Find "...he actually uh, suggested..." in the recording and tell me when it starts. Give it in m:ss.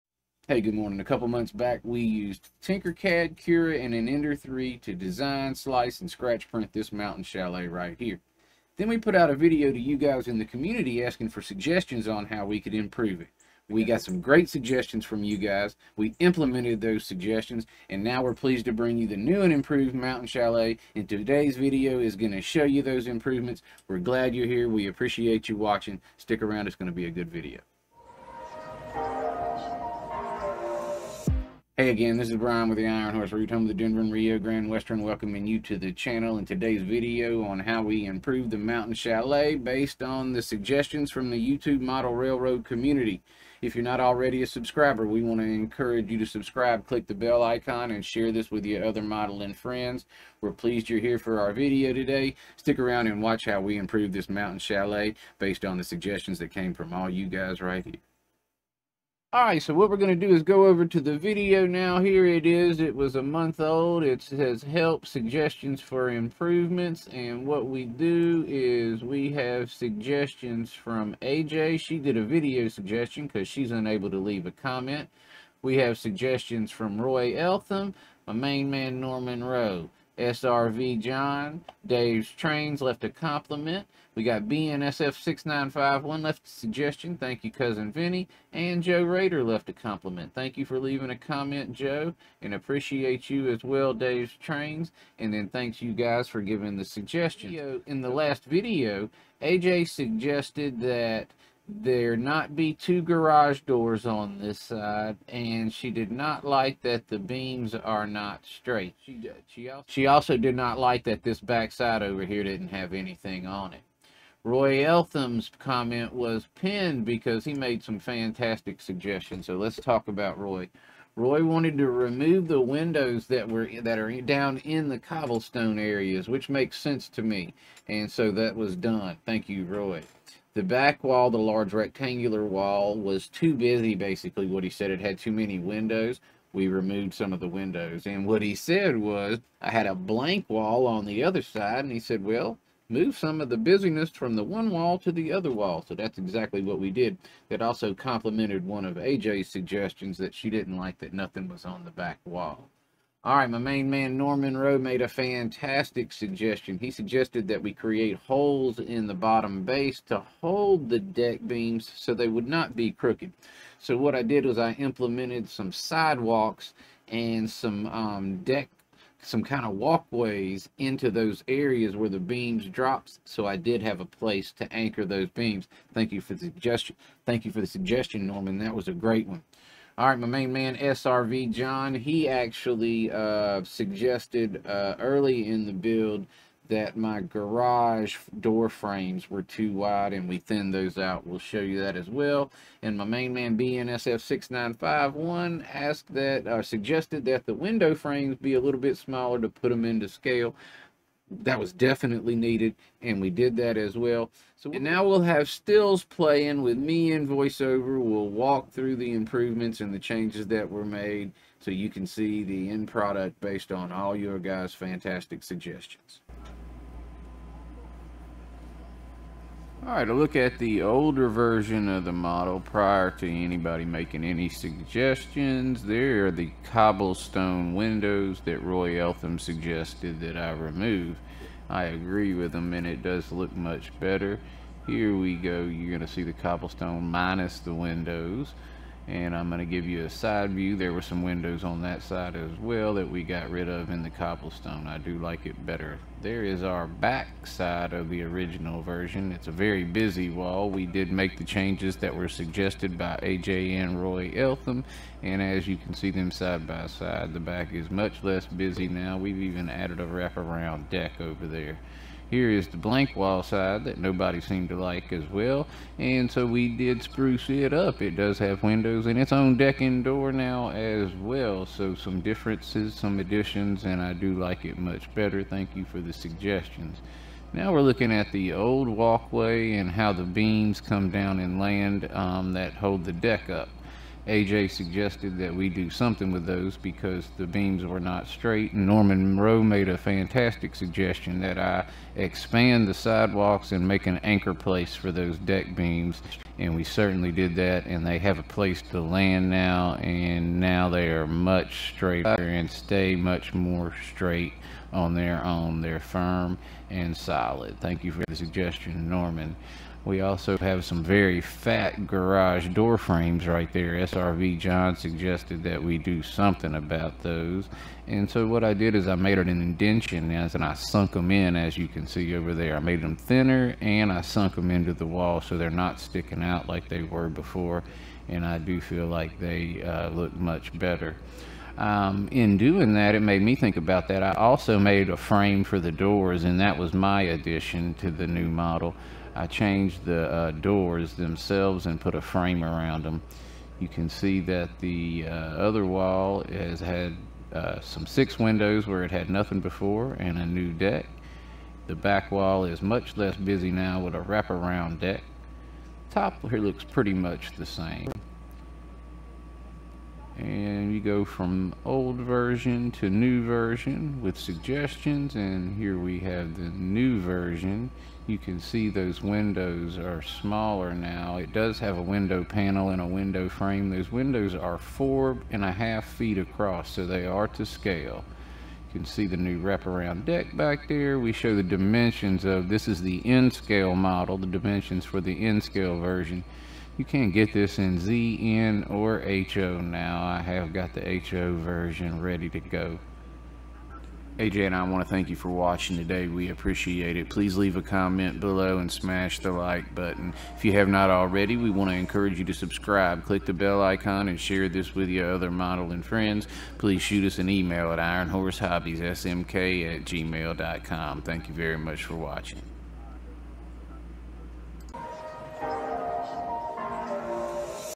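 3:01.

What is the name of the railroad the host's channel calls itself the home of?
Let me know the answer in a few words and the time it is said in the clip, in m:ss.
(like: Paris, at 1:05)
Denver and Rio Grande Western, at 0:33.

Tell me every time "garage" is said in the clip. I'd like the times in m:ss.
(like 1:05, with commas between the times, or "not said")
1:43, 3:07, 5:12.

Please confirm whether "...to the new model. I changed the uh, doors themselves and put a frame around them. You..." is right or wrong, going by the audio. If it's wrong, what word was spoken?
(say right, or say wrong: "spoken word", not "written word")
right.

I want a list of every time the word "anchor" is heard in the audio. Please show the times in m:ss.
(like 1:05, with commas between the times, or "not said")
2:54, 4:54.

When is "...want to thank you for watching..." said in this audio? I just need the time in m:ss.
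6:34.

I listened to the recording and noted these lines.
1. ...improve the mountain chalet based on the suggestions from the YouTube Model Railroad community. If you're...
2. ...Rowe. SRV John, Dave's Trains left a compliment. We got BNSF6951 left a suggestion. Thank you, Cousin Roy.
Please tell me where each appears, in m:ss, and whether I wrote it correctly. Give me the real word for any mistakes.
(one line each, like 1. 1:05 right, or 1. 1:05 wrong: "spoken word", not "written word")
1. 0:38 right
2. 1:19 wrong: "Vinny", not "Roy".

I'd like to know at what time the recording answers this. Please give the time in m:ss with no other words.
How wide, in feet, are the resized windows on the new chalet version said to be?
6:14.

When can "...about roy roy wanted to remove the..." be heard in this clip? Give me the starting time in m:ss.
2:00.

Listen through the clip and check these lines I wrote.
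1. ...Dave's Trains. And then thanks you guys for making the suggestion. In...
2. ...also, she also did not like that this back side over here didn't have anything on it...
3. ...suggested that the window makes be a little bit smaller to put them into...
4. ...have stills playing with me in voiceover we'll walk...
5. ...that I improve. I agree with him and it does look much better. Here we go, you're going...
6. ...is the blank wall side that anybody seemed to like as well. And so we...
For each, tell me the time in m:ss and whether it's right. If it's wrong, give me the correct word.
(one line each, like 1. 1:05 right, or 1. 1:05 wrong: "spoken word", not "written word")
1. 1:33 wrong: "giving", not "making"
2. 1:49 right
3. 3:16 wrong: "frames", not "makes"
4. 3:25 right
5. 3:50 wrong: "remove", not "improve"
6. 4:22 wrong: "nobody", not "anybody".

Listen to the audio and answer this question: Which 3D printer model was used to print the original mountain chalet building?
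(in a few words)
Ender 3.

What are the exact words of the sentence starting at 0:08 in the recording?
Then we put out a video to you guys in the community asking for suggestions on how we could improve it.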